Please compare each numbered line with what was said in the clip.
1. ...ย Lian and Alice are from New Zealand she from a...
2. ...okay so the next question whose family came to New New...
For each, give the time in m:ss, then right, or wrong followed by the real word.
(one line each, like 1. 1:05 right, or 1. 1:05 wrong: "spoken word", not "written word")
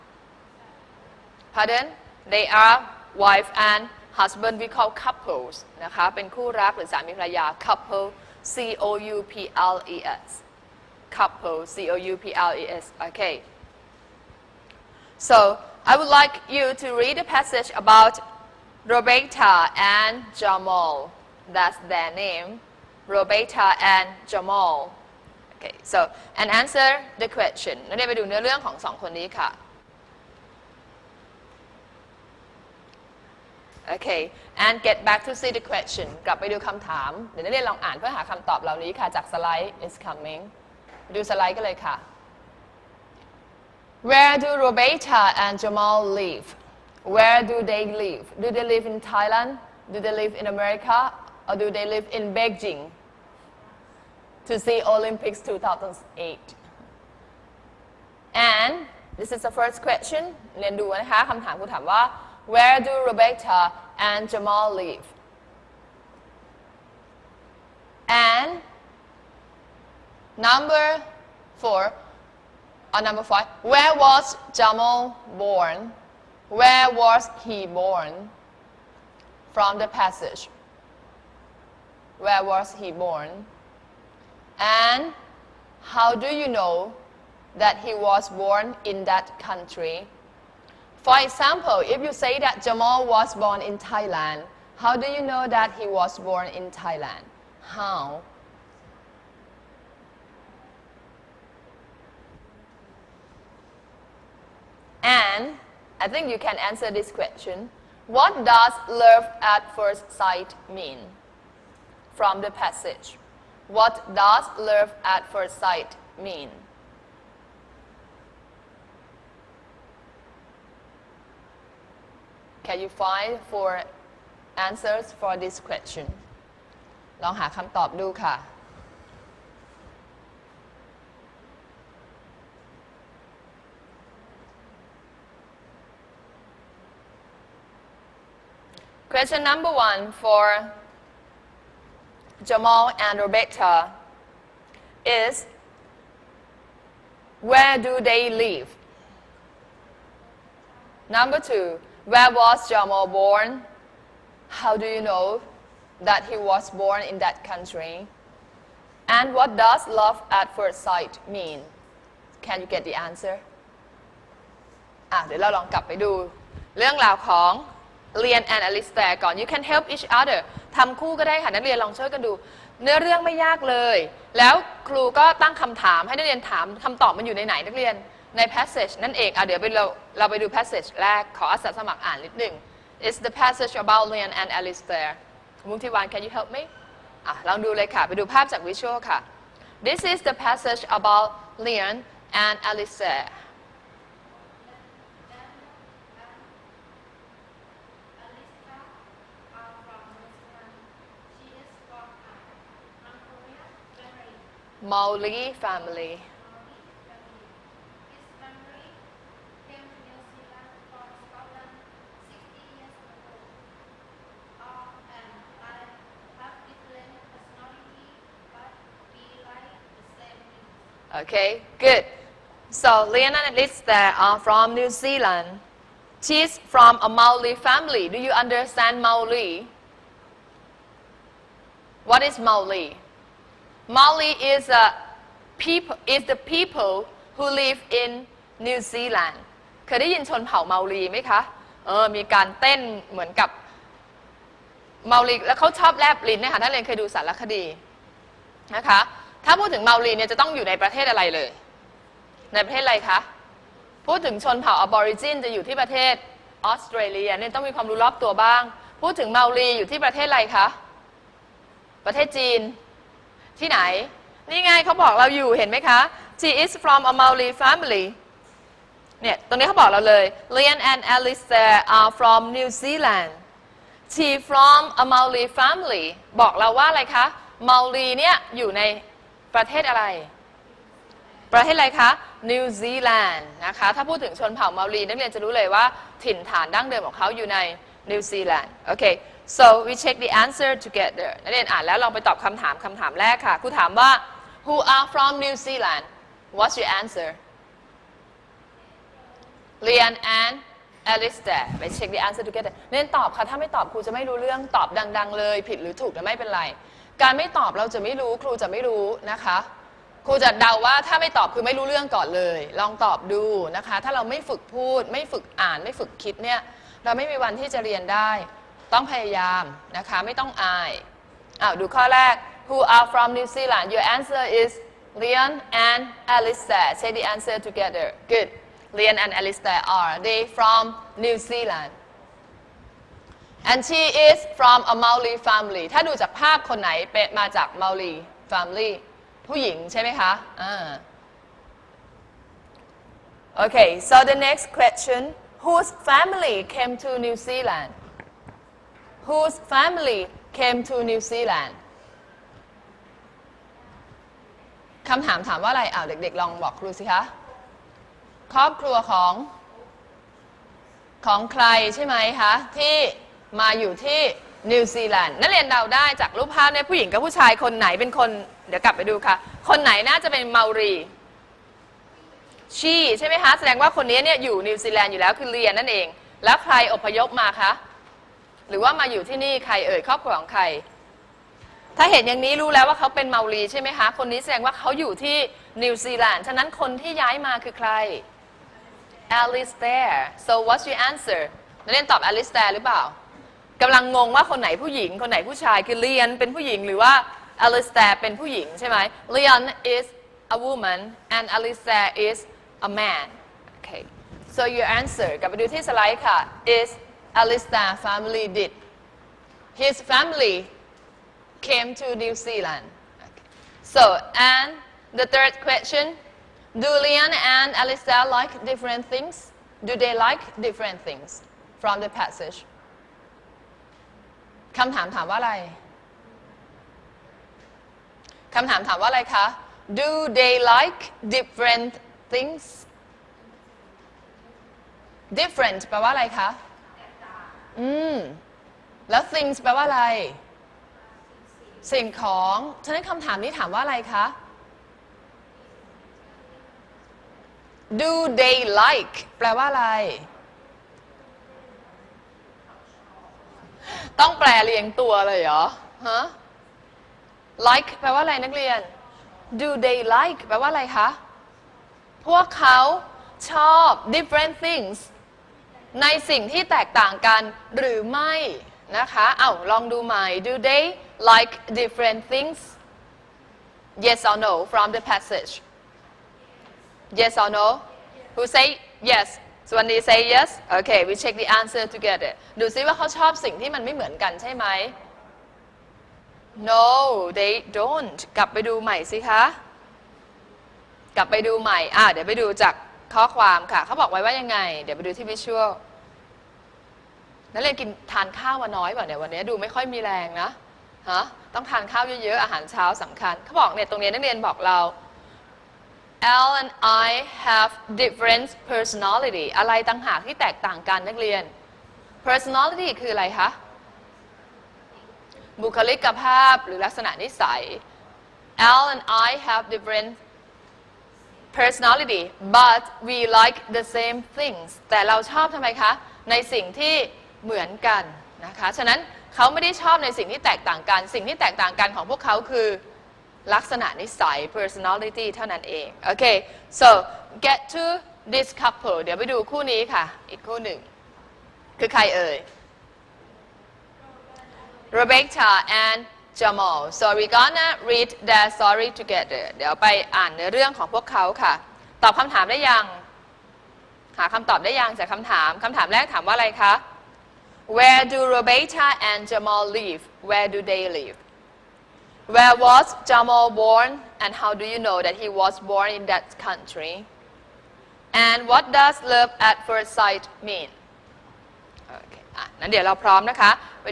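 1. 4:30 right
2. 5:43 wrong: "Zealand", not "New".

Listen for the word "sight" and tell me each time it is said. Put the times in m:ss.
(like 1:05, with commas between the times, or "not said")
1:50, 1:55, 2:40, 9:29.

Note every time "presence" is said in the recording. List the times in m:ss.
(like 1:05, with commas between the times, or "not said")
not said.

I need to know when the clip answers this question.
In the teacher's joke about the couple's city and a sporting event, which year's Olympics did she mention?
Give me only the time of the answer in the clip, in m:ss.
0:54.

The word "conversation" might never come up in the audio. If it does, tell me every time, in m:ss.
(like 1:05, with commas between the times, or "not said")
not said.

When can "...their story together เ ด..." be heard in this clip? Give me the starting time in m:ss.
9:08.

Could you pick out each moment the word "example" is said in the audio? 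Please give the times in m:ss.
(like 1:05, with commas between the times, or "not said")
1:31.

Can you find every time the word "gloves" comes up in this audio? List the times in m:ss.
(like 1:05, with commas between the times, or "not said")
not said.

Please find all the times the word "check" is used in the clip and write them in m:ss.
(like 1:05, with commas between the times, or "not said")
4:50, 8:01.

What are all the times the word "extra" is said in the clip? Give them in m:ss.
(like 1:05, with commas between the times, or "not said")
not said.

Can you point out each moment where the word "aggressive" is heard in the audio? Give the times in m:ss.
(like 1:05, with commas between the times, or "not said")
not said.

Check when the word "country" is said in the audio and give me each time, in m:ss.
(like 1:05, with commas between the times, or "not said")
1:29, 2:37, 9:26.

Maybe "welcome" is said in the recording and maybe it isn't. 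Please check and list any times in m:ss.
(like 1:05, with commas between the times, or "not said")
not said.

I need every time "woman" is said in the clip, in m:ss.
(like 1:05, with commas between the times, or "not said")
6:40.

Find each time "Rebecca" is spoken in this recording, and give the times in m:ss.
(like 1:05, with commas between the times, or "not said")
9:04, 9:18.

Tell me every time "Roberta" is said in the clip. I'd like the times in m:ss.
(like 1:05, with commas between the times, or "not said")
0:18, 0:23, 0:44, 1:03, 2:23.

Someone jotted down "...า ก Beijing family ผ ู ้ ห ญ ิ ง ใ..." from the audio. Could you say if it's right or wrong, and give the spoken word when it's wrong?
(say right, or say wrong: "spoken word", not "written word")
wrong: "Maori", not "Beijing".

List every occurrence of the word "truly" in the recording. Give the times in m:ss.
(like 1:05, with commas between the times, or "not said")
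not said.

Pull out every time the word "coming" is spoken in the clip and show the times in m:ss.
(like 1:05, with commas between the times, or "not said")
0:40.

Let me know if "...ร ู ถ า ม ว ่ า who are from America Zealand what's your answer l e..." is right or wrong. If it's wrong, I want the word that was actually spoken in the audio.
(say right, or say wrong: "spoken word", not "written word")
wrong: "New", not "America".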